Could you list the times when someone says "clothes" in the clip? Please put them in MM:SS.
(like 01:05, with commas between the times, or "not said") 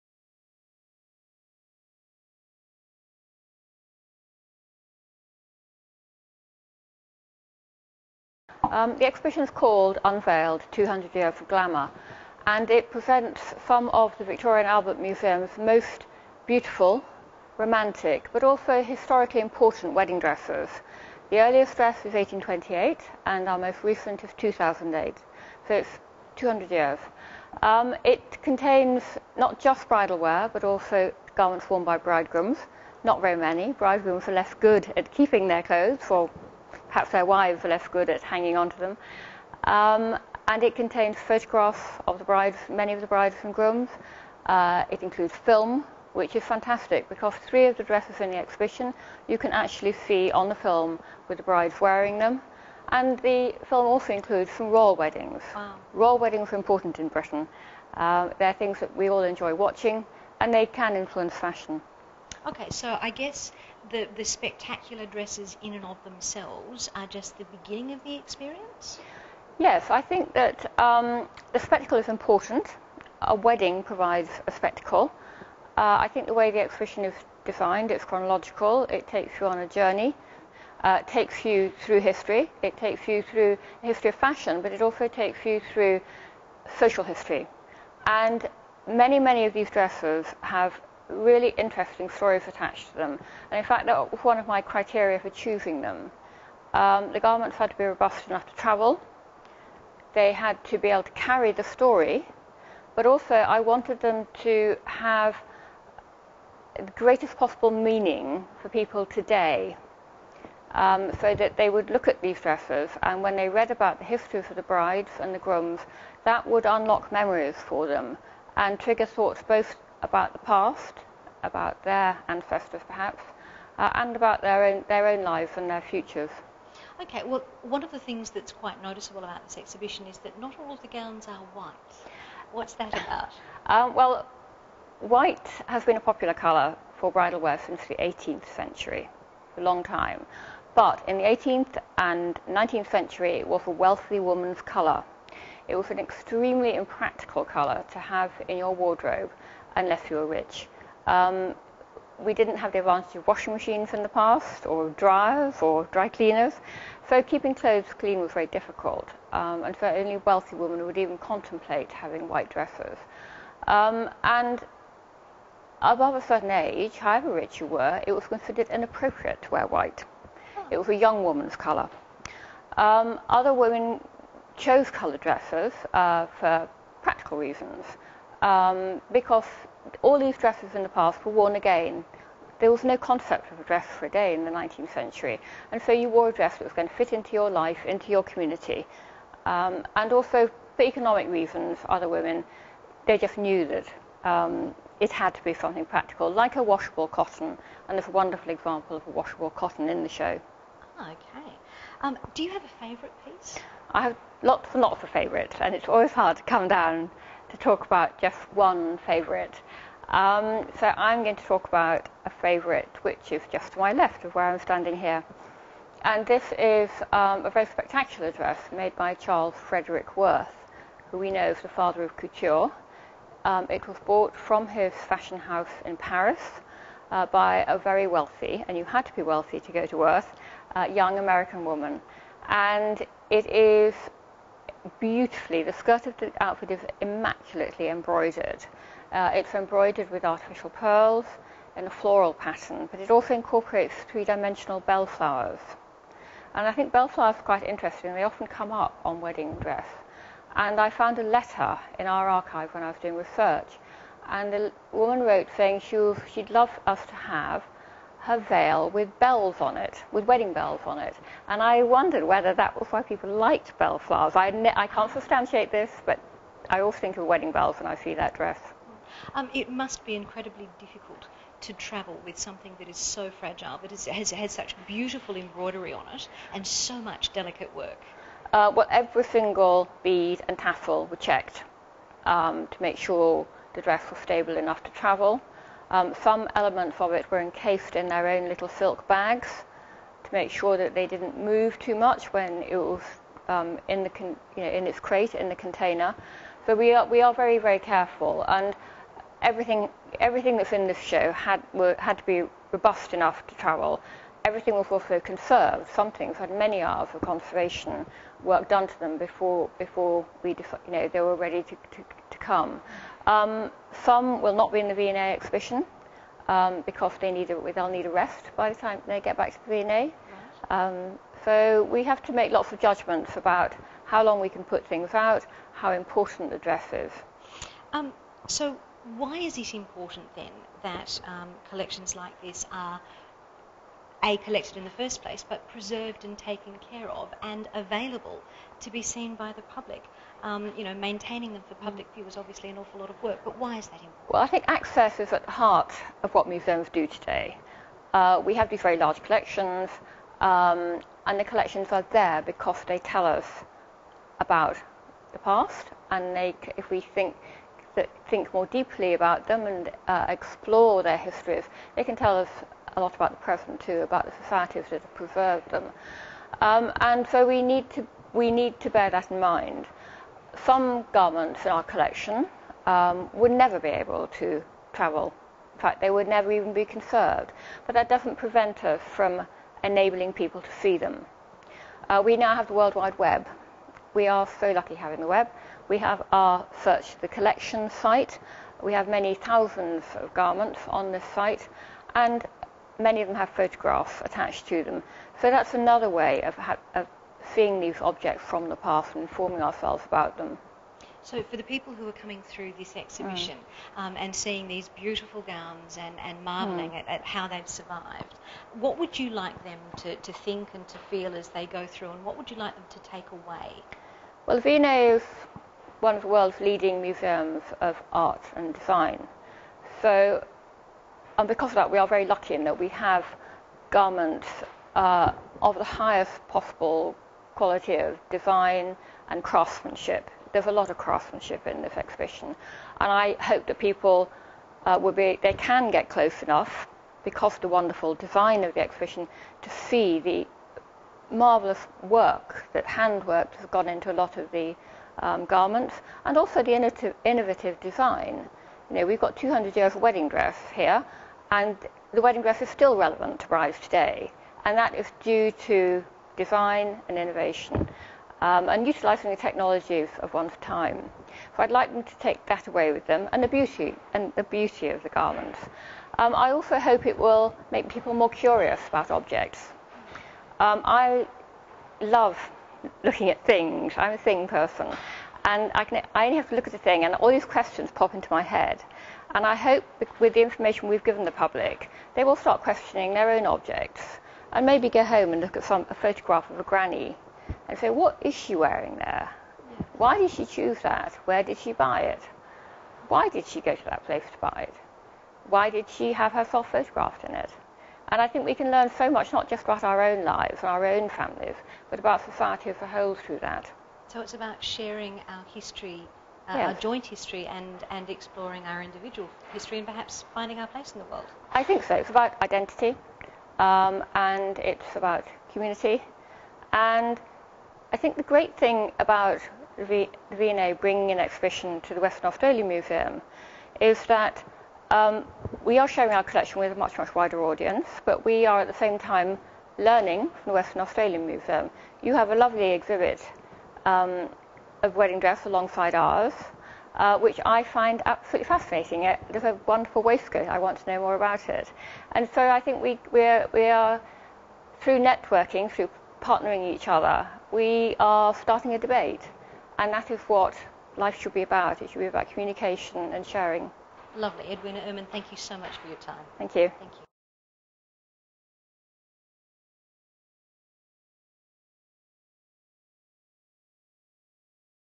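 00:35, 02:37.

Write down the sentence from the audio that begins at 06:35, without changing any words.
So that's another way of, of seeing these objects from the past and informing ourselves about them.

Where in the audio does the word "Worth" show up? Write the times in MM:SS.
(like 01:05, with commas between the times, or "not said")
03:40, 03:49.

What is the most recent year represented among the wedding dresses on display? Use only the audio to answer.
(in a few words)
2008.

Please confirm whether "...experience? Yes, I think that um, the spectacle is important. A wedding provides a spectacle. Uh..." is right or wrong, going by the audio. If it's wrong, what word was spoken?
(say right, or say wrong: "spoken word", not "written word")
right.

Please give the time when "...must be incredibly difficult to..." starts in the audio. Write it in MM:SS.
04:29.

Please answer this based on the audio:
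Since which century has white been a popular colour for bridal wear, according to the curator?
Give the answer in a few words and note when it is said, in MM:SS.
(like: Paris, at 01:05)
18th century, at 02:17.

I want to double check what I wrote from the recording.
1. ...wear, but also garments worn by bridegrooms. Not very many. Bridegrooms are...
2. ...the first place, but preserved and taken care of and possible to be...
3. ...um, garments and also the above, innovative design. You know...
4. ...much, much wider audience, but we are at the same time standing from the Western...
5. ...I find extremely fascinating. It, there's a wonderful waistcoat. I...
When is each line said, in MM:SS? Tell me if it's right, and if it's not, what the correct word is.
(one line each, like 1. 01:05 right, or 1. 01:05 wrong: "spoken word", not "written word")
1. 00:30 right
2. 05:34 wrong: "available", not "possible"
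3. 07:25 wrong: "innovative", not "above"
4. 08:46 wrong: "learning", not "standing"
5. 08:57 wrong: "absolutely", not "extremely".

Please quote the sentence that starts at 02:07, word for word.
Okay, well, one of the things that's quite noticeable about this exhibition is that not all of the gowns are white.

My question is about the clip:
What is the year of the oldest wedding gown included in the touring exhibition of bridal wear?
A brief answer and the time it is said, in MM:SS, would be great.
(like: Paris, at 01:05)
1828, at 00:22.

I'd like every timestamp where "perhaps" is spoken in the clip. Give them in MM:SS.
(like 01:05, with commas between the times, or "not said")
00:36, 02:02, 08:29.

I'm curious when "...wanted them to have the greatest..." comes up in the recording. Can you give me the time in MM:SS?
01:43.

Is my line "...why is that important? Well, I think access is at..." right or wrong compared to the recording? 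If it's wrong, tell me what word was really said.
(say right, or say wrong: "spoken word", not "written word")
right.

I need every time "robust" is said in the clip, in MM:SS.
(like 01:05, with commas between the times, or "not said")
01:37, 05:02.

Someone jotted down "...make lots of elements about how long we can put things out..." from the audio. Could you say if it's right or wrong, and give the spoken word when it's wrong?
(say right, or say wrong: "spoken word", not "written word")
wrong: "judgments", not "elements".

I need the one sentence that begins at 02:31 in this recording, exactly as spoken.
Um, we didn't have the advantage of washing machines in the past, or dryers, or dry cleaners.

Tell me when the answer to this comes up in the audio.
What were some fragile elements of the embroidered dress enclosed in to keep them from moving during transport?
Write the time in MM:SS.
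04:48.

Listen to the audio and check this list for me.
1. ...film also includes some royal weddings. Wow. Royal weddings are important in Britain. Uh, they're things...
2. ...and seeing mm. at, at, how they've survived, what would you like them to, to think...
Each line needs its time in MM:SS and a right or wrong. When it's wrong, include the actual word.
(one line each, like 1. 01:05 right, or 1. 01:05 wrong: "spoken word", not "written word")
1. 00:53 right
2. 06:46 wrong: "marvelling", not "seeing".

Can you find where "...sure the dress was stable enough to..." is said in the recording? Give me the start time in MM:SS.
04:42.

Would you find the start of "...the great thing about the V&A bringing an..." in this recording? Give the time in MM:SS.
08:38.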